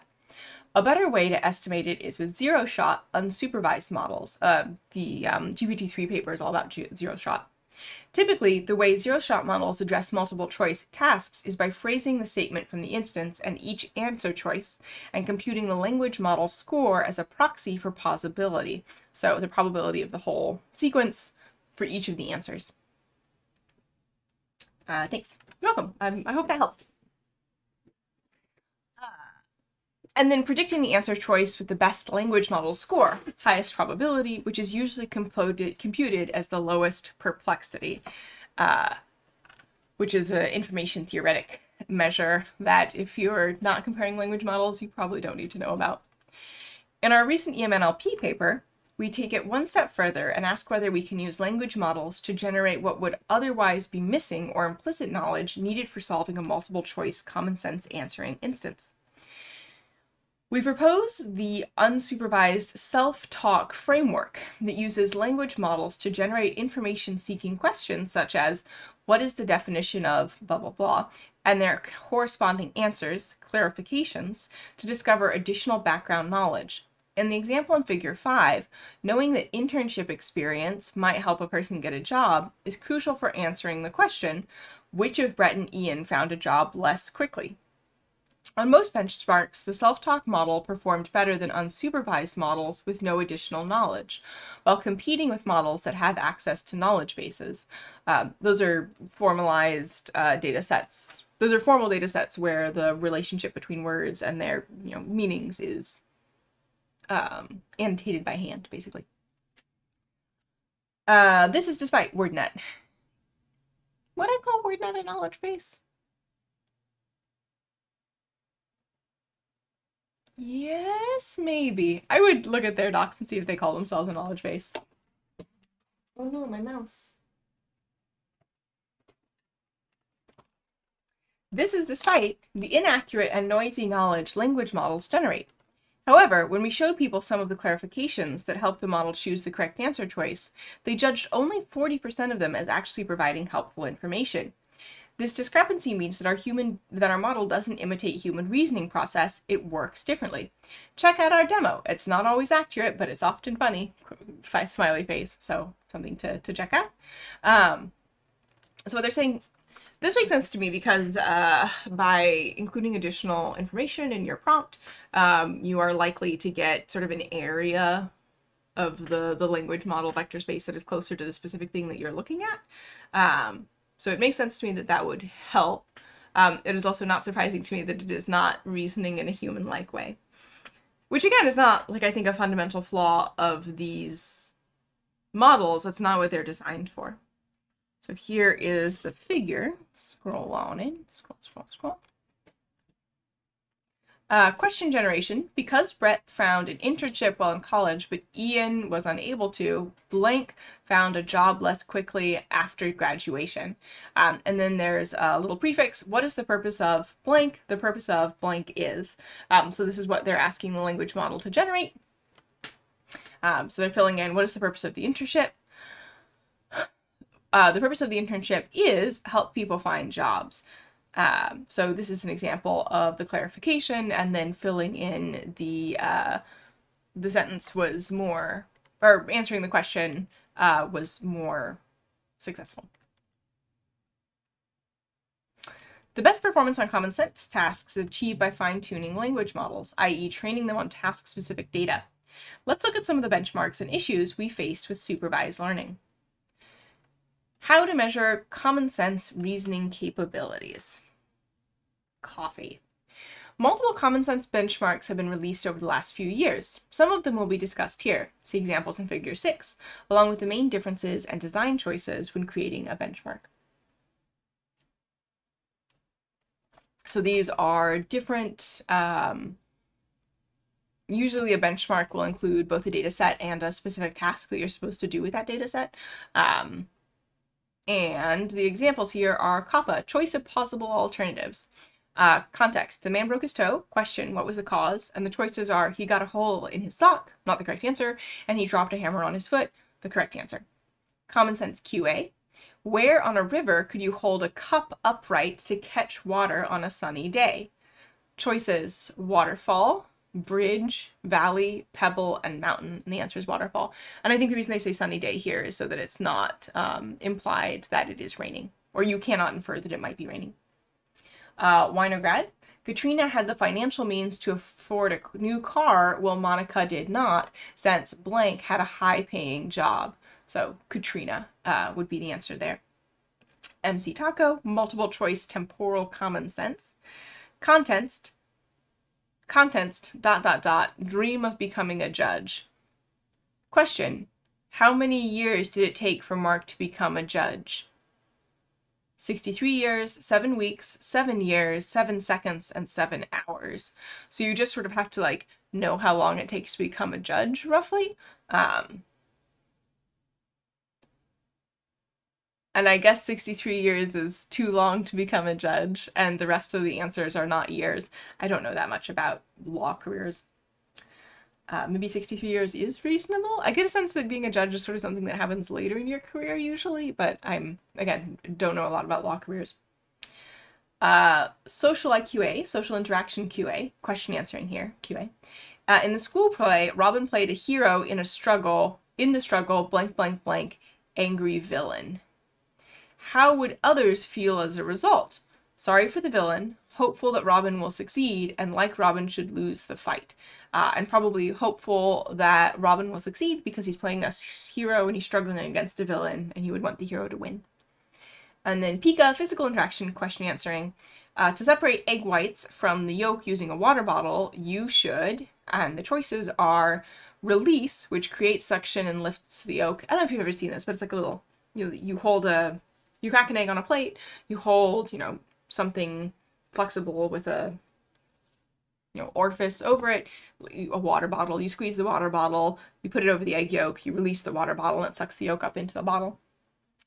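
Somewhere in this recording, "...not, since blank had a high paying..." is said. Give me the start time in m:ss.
5:17.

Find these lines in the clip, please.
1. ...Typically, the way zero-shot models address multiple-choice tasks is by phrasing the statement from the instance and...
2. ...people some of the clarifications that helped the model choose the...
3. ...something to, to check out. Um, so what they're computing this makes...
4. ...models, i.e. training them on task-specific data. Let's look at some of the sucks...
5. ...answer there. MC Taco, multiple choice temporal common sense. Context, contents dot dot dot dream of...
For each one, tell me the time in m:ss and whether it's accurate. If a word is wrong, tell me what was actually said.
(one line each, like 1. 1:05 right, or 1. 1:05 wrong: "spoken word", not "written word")
1. 0:08 right
2. 2:16 right
3. 2:35 wrong: "saying", not "computing"
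4. 3:59 wrong: "benchmarks", not "sucks"
5. 5:22 right.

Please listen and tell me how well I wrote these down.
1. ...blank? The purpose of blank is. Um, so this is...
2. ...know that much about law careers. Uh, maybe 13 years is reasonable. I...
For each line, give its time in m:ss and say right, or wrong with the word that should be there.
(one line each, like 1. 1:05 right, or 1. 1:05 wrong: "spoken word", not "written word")
1. 3:27 right
2. 5:58 wrong: "63", not "13".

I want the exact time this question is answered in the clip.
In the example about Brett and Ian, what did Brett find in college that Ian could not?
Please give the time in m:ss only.
3:16.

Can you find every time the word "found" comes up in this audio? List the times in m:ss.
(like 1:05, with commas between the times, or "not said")
1:26, 3:16, 3:20.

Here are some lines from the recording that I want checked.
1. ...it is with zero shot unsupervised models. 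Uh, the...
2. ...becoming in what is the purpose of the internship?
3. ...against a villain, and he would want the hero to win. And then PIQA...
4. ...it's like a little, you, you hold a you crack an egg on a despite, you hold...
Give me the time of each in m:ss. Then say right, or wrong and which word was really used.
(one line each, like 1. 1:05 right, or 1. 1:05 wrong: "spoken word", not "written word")
1. 0:01 right
2. 3:33 wrong: "filling", not "becoming"
3. 6:35 right
4. 6:50 wrong: "plate", not "despite".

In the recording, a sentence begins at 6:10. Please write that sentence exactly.
Uh, social IQA, social interaction QA, question answering here, QA.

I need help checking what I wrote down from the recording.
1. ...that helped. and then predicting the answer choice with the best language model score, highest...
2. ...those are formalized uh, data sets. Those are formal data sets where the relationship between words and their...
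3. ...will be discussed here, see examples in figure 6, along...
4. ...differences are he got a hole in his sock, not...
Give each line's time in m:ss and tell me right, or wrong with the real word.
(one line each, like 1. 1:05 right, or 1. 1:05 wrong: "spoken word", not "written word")
1. 0:26 right
2. 1:38 right
3. 4:17 right
4. 4:45 wrong: "choices", not "differences".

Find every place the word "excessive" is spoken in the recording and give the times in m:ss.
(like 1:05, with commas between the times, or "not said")
not said.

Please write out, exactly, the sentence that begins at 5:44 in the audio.
So you just sort of have to like know how long it takes to become a judge, roughly.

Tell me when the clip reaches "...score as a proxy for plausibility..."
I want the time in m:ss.
0:16.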